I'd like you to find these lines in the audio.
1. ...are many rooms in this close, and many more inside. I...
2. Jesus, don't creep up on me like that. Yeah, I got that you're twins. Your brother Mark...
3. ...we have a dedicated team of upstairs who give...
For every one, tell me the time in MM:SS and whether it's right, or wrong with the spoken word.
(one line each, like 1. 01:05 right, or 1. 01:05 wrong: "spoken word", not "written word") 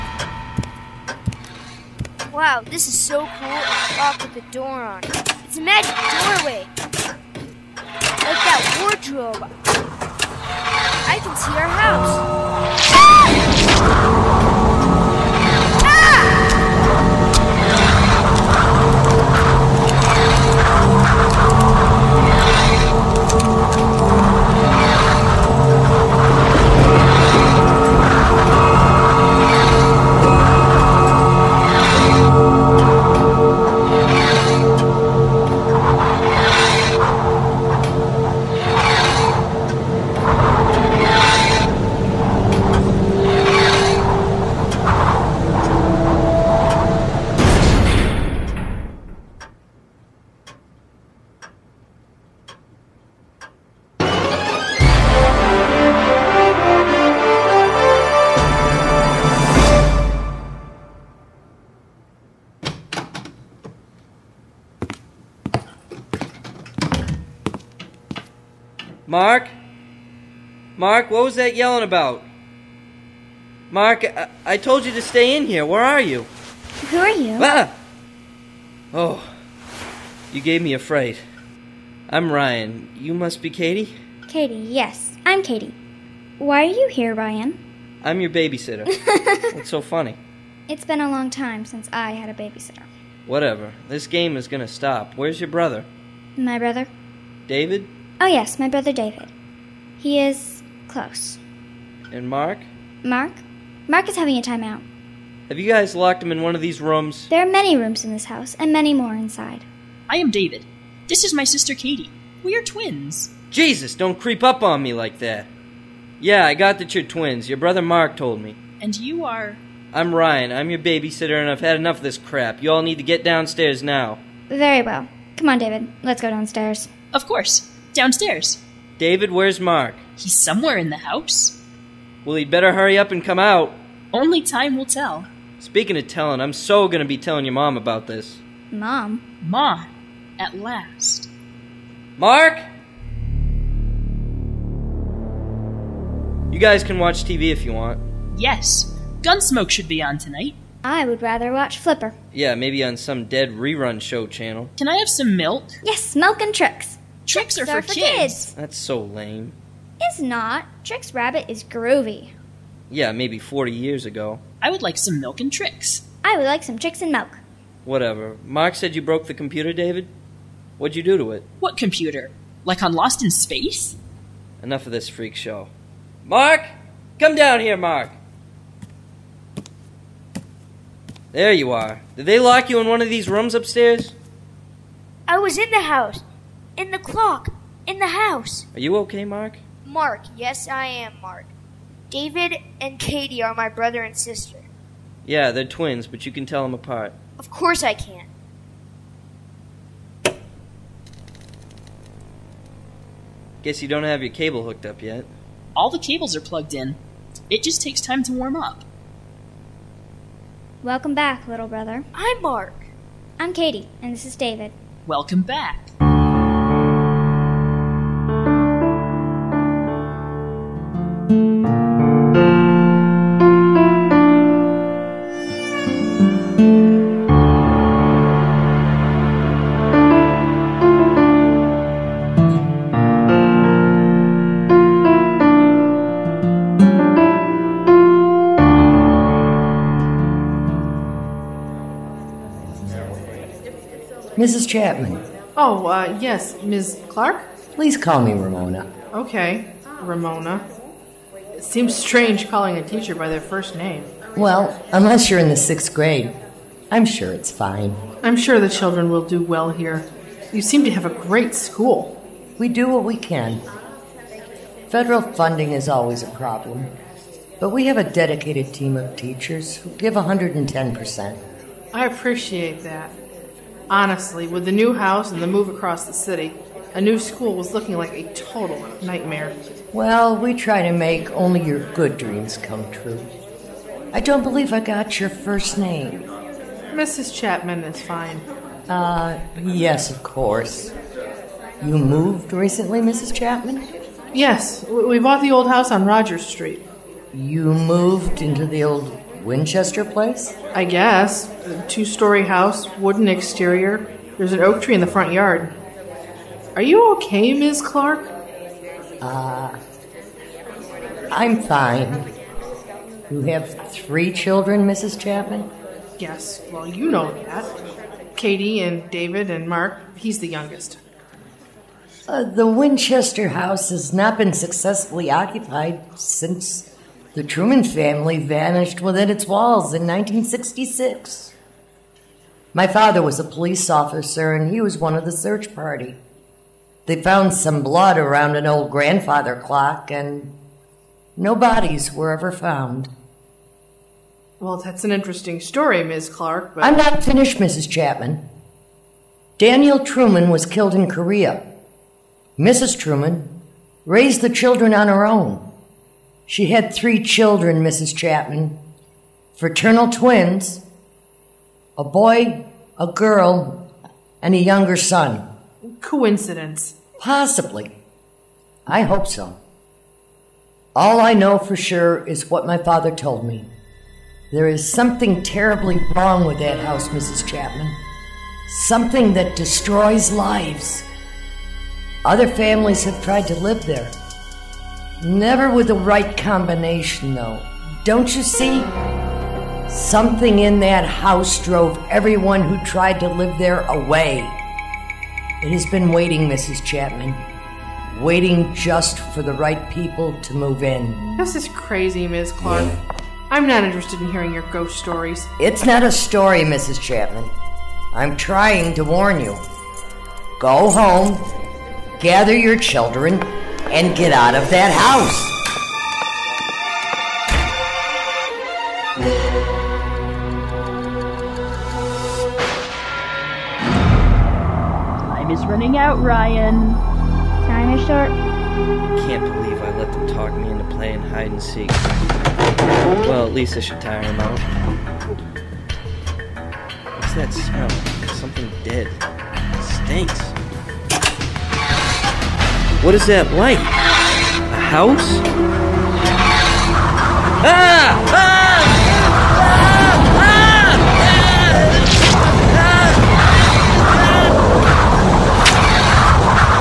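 1. 01:47 wrong: "house", not "close"
2. 01:53 right
3. 04:27 wrong: "teachers", not "upstairs".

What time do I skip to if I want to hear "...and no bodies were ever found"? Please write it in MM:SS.
05:40.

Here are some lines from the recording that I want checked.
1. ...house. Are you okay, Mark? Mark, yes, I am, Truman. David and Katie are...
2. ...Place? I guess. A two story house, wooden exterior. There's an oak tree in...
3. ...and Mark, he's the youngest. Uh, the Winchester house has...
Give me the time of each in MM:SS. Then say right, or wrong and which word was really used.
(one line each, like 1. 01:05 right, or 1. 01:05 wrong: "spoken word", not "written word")
1. 03:08 wrong: "Mark", not "Truman"
2. 05:00 right
3. 05:19 right.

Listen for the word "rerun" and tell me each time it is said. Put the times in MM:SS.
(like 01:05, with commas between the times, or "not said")
02:33.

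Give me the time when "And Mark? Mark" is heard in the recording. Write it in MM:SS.
01:42.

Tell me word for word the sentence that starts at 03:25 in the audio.
All the cables are plugged in.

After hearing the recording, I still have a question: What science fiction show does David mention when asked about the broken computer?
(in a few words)
Lost in Space.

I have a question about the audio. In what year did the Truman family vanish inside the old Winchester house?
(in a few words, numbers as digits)
1966.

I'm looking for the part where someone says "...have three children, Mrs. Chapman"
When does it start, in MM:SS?
05:13.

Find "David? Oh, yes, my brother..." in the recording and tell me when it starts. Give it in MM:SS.
01:37.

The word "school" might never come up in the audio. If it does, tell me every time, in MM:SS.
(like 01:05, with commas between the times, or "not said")
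04:21, 04:37.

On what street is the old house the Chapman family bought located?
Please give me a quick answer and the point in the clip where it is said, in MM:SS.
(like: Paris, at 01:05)
Rogers Street, at 04:56.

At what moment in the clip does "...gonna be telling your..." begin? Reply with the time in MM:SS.
02:16.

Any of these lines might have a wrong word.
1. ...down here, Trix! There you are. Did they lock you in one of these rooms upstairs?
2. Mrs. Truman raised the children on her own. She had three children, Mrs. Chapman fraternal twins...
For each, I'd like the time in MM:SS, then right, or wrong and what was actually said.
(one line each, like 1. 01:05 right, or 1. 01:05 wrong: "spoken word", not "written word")
1. 02:57 wrong: "Mark", not "Trix"
2. 05:52 right.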